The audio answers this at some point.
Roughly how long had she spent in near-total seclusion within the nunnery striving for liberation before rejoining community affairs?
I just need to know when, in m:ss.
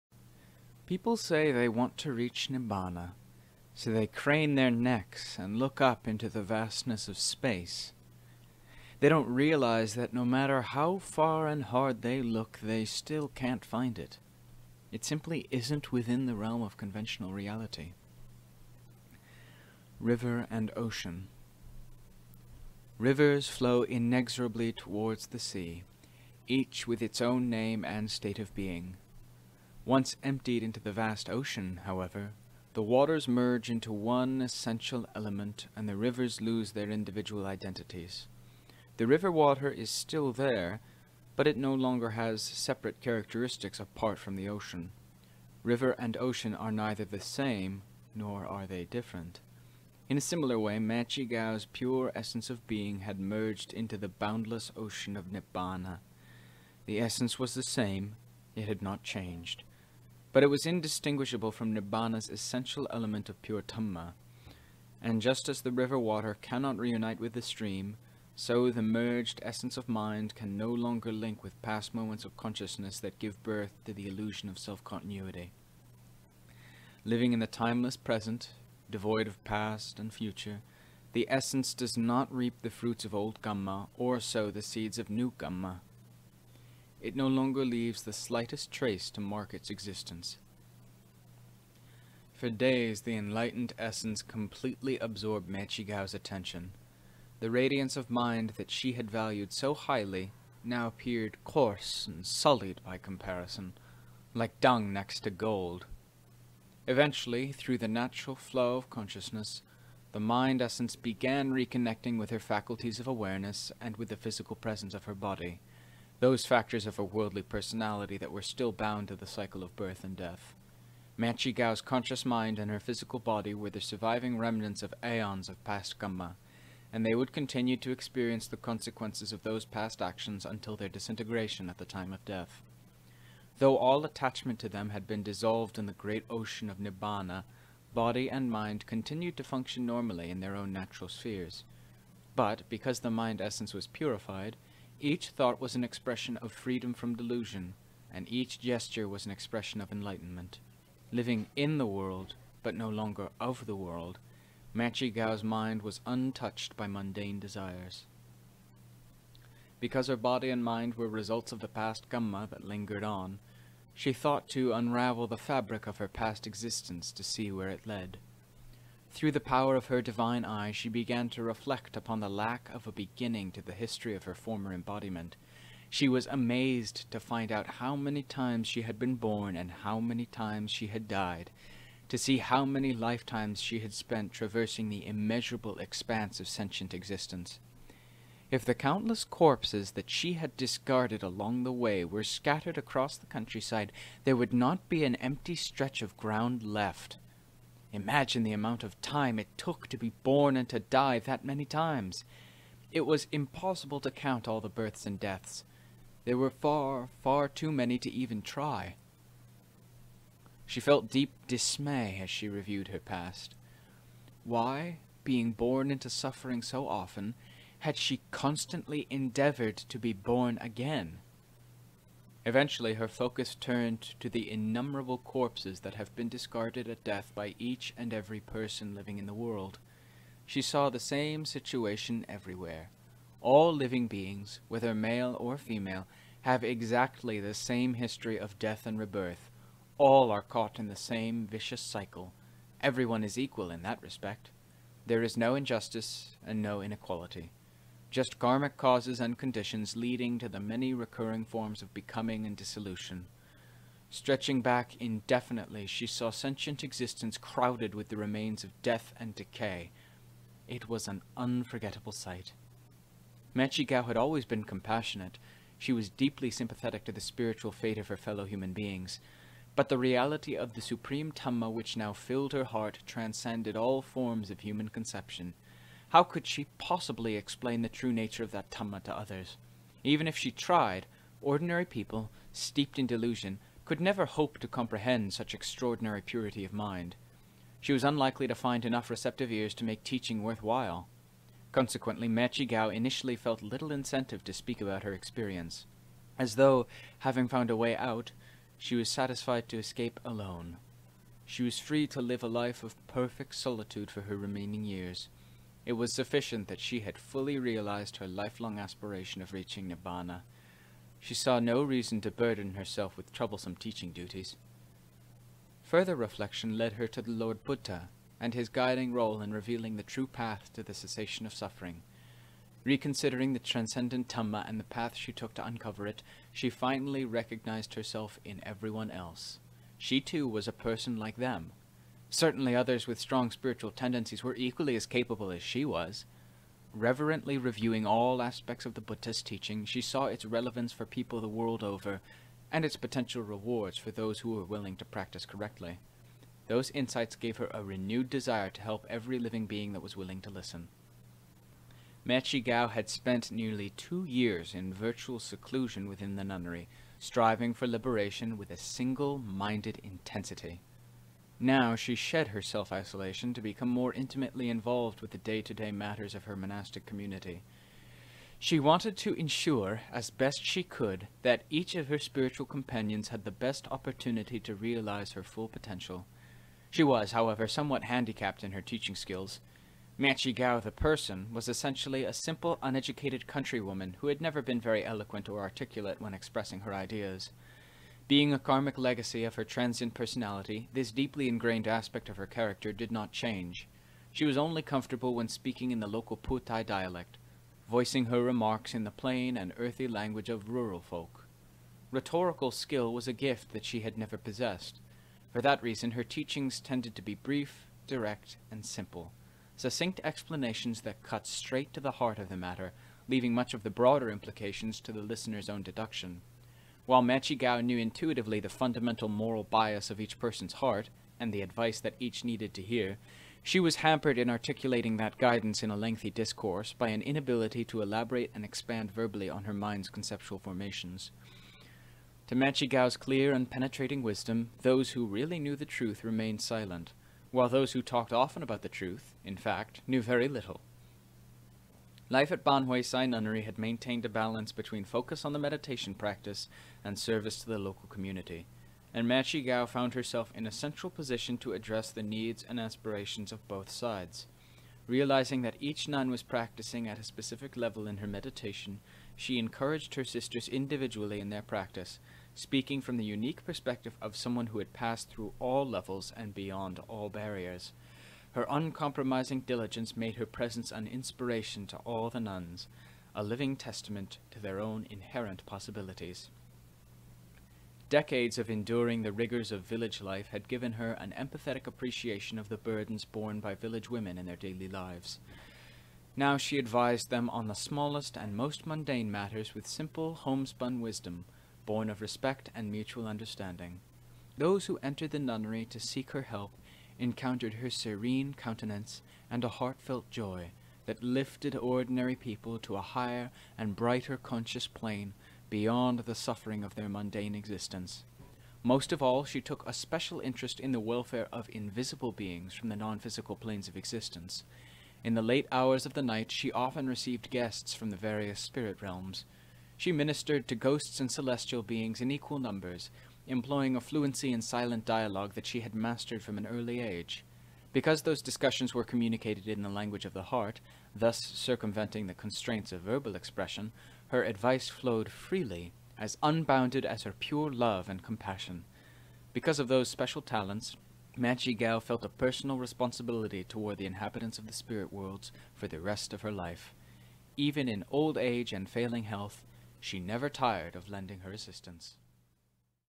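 5:53.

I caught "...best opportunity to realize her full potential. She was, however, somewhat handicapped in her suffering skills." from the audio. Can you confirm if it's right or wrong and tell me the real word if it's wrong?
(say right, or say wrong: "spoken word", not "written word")
wrong: "teaching", not "suffering".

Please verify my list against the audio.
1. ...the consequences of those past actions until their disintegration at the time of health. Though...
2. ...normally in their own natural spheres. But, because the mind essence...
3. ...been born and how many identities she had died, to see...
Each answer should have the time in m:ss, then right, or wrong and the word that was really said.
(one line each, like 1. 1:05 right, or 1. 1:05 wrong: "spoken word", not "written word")
1. 2:08 wrong: "death", not "health"
2. 2:19 right
3. 2:58 wrong: "times", not "identities".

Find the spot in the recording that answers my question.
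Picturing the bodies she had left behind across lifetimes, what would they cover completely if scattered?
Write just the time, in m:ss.
3:13.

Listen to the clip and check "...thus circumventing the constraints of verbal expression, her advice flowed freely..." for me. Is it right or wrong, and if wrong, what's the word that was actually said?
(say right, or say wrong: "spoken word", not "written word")
right.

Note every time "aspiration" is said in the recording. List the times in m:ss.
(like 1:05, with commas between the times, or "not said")
5:08, 7:32.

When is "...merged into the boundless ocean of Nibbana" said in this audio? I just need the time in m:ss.
0:53.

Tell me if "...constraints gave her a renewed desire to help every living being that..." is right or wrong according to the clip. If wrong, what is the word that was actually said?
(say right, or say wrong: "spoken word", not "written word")
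wrong: "insights", not "constraints".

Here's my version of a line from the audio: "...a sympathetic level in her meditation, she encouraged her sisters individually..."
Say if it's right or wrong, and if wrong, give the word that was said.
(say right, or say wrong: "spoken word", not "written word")
wrong: "specific", not "sympathetic".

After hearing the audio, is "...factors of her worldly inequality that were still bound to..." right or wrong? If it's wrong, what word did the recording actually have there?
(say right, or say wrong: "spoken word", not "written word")
wrong: "personality", not "inequality".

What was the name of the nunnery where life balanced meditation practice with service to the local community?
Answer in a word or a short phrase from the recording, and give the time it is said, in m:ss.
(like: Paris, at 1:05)
Baan Huay Sai Nunnery, at 7:22.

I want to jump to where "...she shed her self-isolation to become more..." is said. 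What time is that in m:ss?
6:01.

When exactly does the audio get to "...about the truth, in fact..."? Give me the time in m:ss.
7:18.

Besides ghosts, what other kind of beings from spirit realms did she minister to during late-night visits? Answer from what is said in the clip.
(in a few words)
celestial beings.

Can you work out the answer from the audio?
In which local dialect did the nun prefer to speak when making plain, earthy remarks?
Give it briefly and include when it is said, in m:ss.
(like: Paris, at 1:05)
Phu Tai, at 6:36.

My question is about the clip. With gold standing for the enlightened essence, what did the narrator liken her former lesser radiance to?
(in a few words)
dung.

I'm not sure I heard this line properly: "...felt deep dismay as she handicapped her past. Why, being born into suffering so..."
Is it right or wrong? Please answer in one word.
wrong.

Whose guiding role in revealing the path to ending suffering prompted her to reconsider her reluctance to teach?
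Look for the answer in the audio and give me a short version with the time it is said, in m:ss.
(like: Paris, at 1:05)
the Lord Buddha, at 5:17.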